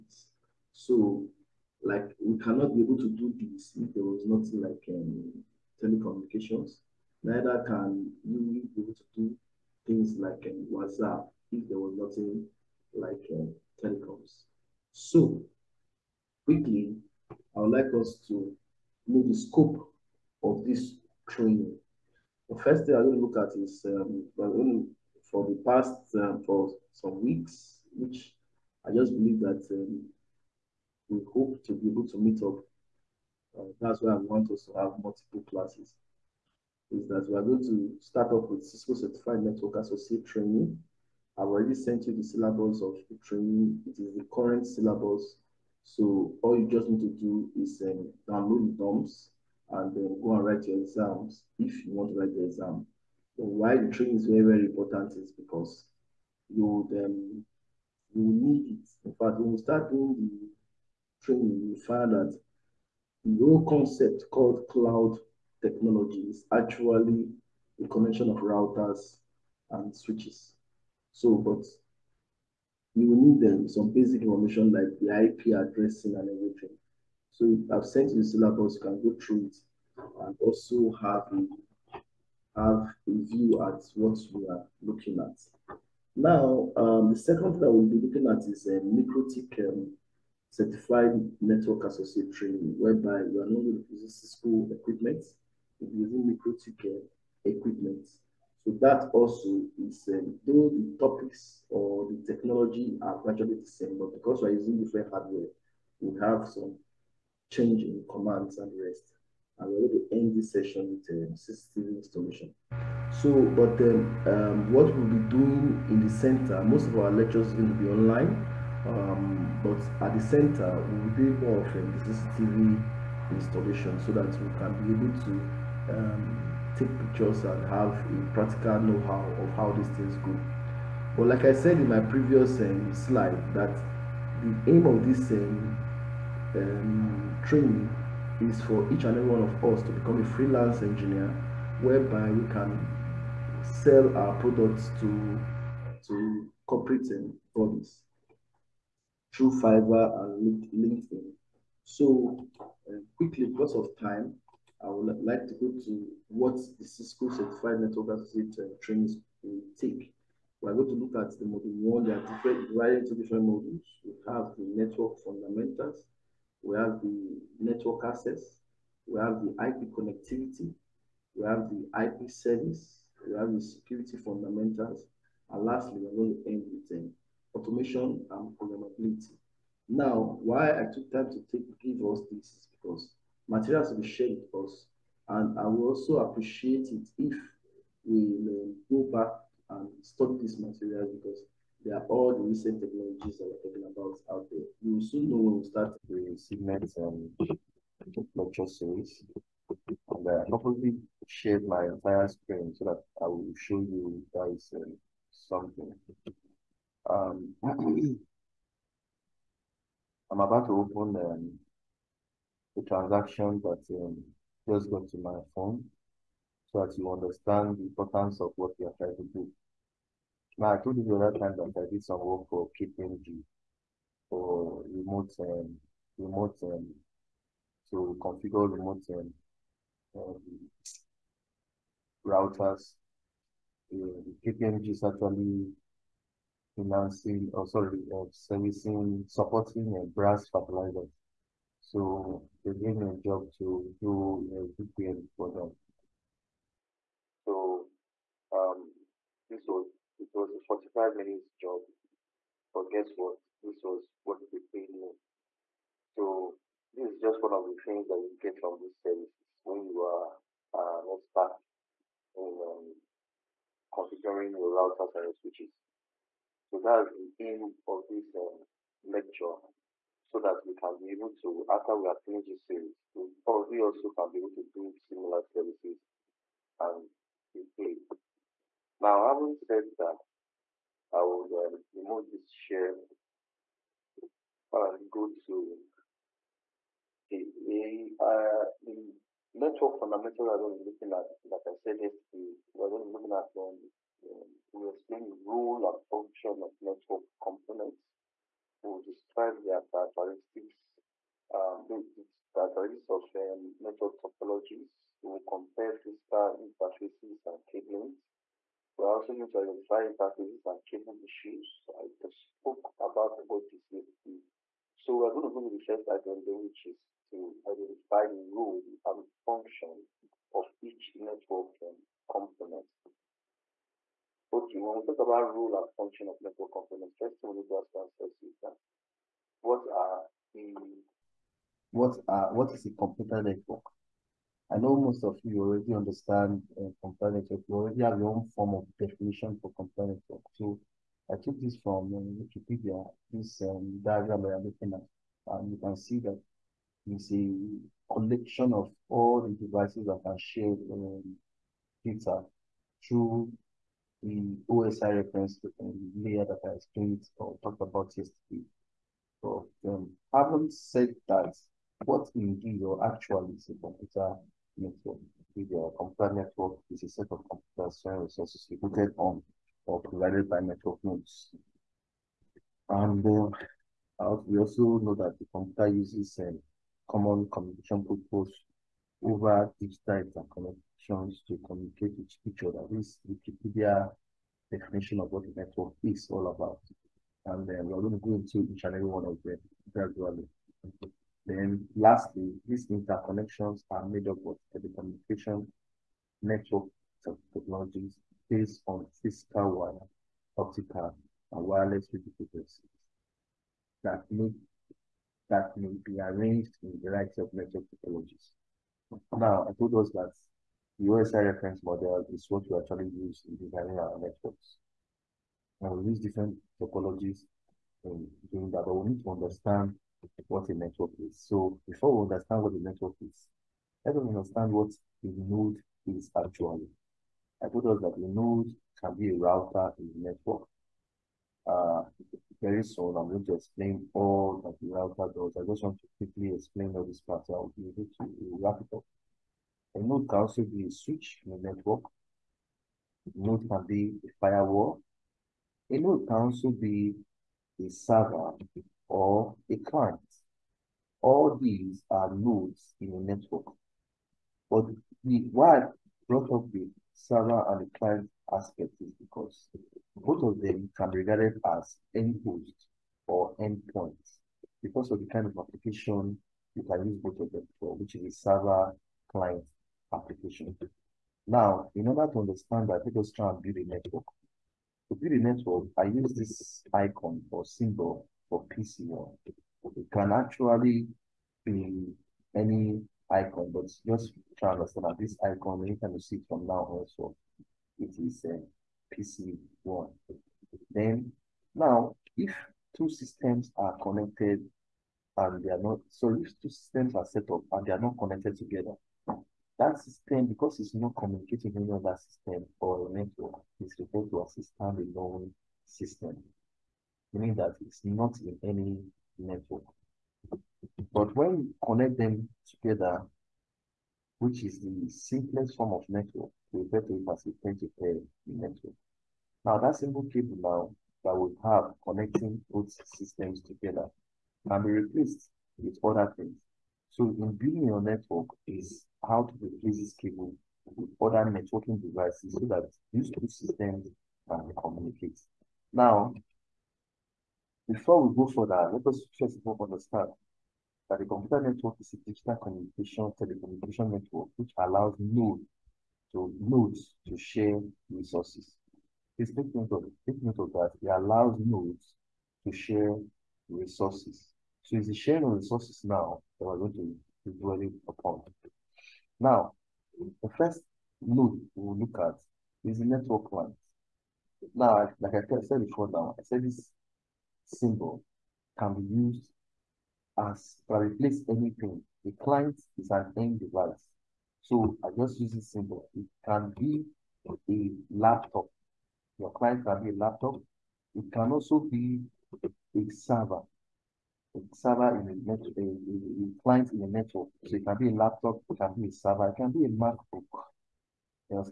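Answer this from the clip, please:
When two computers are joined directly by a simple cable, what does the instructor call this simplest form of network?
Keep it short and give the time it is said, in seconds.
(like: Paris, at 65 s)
Peer to network, at 517 s.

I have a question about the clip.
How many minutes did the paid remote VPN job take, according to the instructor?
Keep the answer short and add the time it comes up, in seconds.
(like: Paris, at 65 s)
45, at 250 s.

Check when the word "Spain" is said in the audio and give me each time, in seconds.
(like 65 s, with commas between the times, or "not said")
not said.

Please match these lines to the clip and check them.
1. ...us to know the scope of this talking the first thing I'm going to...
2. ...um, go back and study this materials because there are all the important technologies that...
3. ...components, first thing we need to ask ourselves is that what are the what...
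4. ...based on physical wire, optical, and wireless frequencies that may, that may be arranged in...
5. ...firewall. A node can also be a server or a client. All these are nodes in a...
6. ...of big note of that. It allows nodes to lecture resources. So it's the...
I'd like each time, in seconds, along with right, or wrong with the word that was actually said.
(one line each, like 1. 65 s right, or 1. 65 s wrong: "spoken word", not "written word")
1. 17 s wrong: "training", not "talking"
2. 188 s wrong: "recent", not "important"
3. 326 s right
4. 398 s right
5. 444 s right
6. 549 s wrong: "share", not "lecture".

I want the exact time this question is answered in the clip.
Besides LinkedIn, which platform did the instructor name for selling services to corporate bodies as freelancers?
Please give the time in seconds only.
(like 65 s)
149 s.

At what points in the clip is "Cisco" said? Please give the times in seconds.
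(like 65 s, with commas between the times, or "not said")
38 s, 94 s, 156 s.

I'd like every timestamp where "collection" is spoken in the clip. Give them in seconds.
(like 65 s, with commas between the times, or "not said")
348 s.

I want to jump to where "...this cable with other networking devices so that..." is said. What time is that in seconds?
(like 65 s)
529 s.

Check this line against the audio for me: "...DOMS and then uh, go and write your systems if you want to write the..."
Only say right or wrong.
wrong.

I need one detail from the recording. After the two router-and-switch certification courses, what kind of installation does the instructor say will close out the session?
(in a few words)
System installation.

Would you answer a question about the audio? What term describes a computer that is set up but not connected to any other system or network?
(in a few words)
Standalone system.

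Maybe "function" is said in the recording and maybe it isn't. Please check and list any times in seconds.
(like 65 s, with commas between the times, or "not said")
296 s, 319 s, 325 s.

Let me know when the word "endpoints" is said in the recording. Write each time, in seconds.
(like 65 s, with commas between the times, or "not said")
463 s.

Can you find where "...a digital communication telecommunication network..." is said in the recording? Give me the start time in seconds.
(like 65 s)
542 s.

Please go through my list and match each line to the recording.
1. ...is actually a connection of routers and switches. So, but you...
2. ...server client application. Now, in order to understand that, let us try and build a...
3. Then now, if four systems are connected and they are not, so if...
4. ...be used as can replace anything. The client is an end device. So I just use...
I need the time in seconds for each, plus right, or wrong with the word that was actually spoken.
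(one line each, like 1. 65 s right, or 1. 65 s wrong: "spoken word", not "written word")
1. 66 s right
2. 468 s right
3. 490 s wrong: "two", not "four"
4. 568 s right.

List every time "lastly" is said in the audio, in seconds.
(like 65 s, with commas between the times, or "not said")
175 s, 391 s.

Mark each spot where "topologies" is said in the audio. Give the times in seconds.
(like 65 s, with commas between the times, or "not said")
304 s, 416 s.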